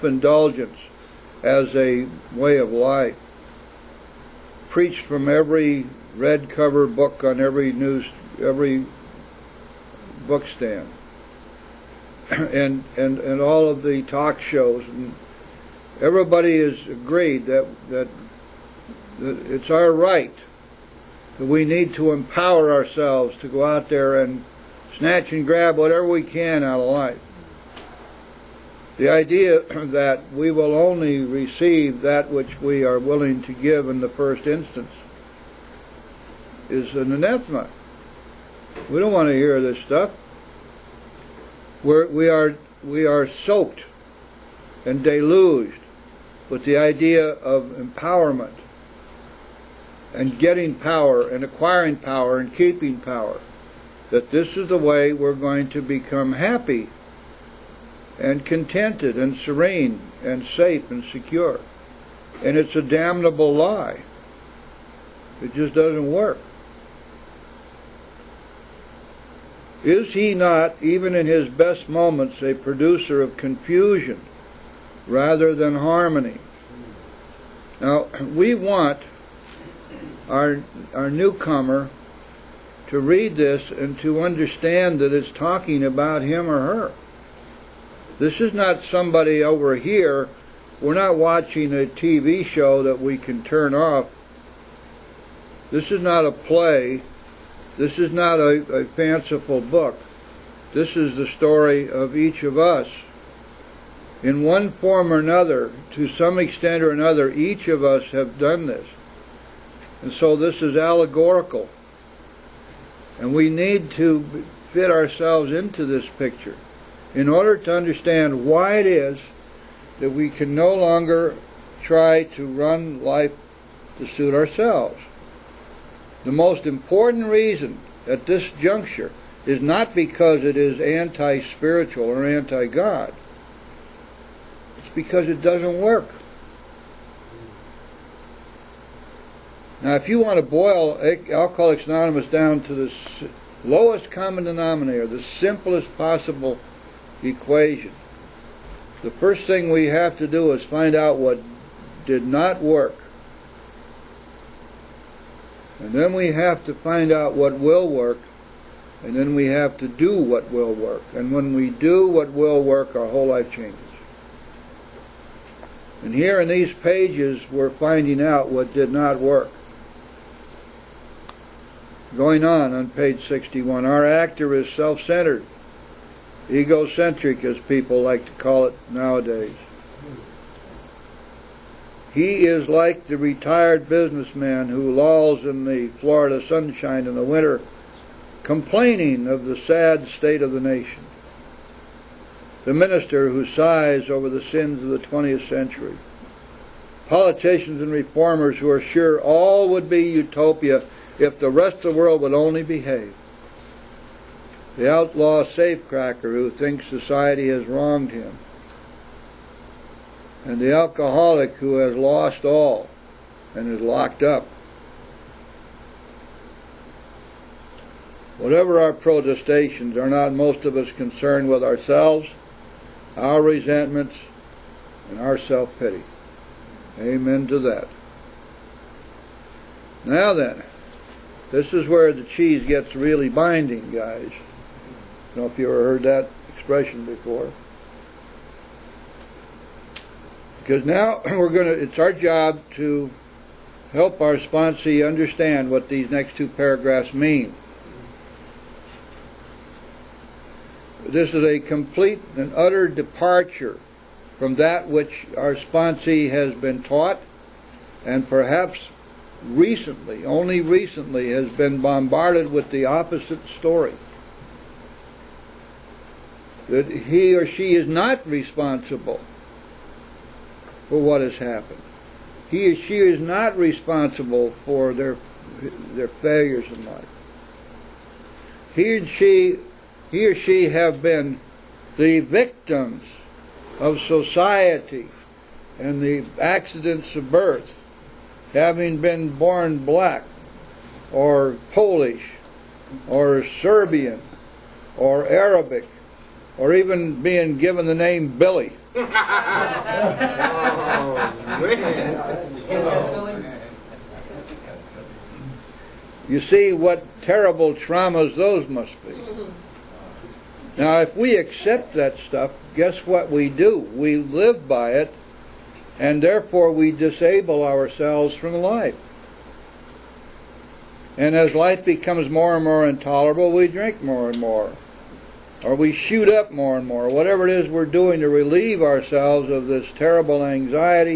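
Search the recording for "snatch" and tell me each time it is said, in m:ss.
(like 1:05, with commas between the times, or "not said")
0:24.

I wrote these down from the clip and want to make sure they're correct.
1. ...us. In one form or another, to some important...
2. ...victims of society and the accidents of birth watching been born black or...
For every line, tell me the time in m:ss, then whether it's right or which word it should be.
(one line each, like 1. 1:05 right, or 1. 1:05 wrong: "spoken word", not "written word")
1. 1:42 wrong: "extent", not "important"
2. 4:42 wrong: "having", not "watching".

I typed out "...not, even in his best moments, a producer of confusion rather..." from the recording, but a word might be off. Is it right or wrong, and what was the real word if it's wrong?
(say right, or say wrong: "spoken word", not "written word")
right.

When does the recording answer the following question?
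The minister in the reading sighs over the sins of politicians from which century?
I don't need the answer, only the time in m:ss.
3:15.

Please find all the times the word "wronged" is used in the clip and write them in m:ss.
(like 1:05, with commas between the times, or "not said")
3:27.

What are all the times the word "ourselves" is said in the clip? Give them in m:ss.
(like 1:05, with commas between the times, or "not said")
0:22, 1:54, 2:04, 3:41, 5:17, 5:28.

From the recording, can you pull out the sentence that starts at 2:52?
Going on on page 61, our actor is self centered, egocentric, as people like to call it nowadays.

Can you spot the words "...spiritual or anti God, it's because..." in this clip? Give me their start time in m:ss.
2:11.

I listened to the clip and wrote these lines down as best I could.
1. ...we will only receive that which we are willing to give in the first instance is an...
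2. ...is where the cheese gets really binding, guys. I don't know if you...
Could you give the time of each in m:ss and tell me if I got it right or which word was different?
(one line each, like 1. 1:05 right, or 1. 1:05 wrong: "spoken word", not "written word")
1. 0:30 right
2. 3:51 right.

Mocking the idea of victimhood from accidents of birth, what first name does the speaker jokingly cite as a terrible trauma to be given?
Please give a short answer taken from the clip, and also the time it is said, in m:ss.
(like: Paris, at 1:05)
Billy, at 4:58.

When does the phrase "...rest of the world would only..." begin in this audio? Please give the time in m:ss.
3:21.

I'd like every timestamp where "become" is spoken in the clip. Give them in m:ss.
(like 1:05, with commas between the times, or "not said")
0:55, 5:21.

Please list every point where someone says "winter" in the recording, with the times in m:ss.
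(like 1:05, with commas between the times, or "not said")
3:07.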